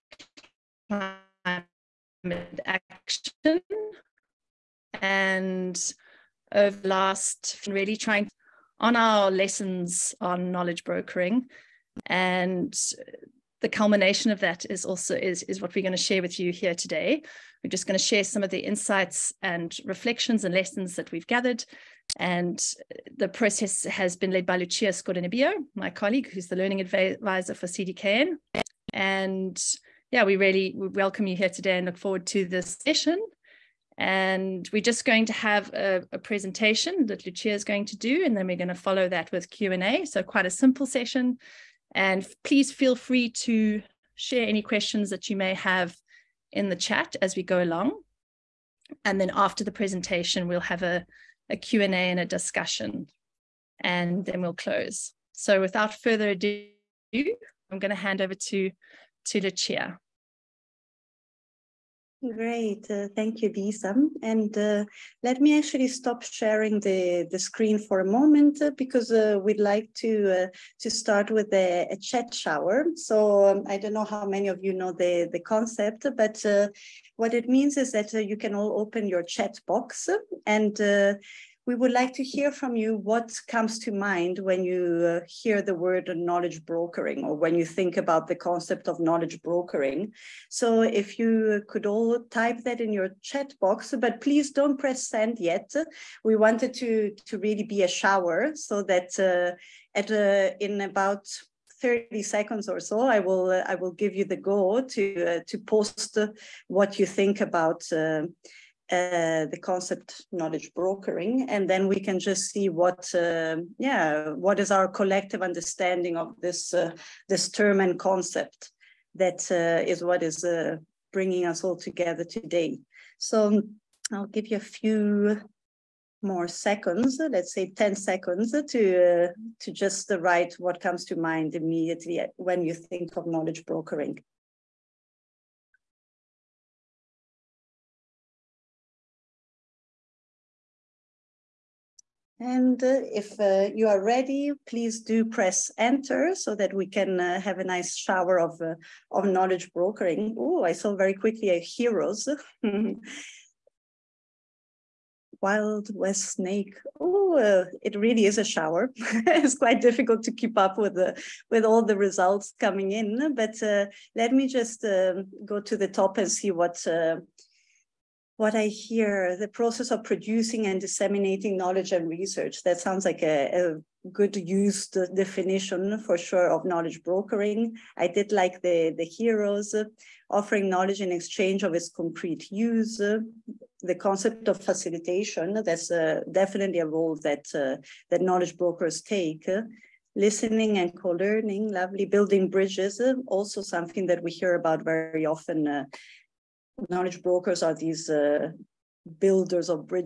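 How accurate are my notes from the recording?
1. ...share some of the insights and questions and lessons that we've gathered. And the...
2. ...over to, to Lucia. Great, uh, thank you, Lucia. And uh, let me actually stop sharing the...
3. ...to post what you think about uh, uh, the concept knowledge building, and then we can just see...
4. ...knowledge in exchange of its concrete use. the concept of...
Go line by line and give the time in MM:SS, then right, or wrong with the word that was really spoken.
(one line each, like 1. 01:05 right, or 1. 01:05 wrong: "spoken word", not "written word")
1. 00:18 wrong: "reflections", not "questions"
2. 00:58 wrong: "Lisa", not "Lucia"
3. 01:45 wrong: "brokering", not "building"
4. 03:00 right.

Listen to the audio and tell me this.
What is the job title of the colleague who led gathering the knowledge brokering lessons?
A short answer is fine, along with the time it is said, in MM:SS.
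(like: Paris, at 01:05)
learning advisor, at 00:26.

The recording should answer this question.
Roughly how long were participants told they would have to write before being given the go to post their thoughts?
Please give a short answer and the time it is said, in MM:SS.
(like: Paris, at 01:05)
30 seconds, at 01:41.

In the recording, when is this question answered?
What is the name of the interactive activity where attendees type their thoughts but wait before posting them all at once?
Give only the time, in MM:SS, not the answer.
01:11.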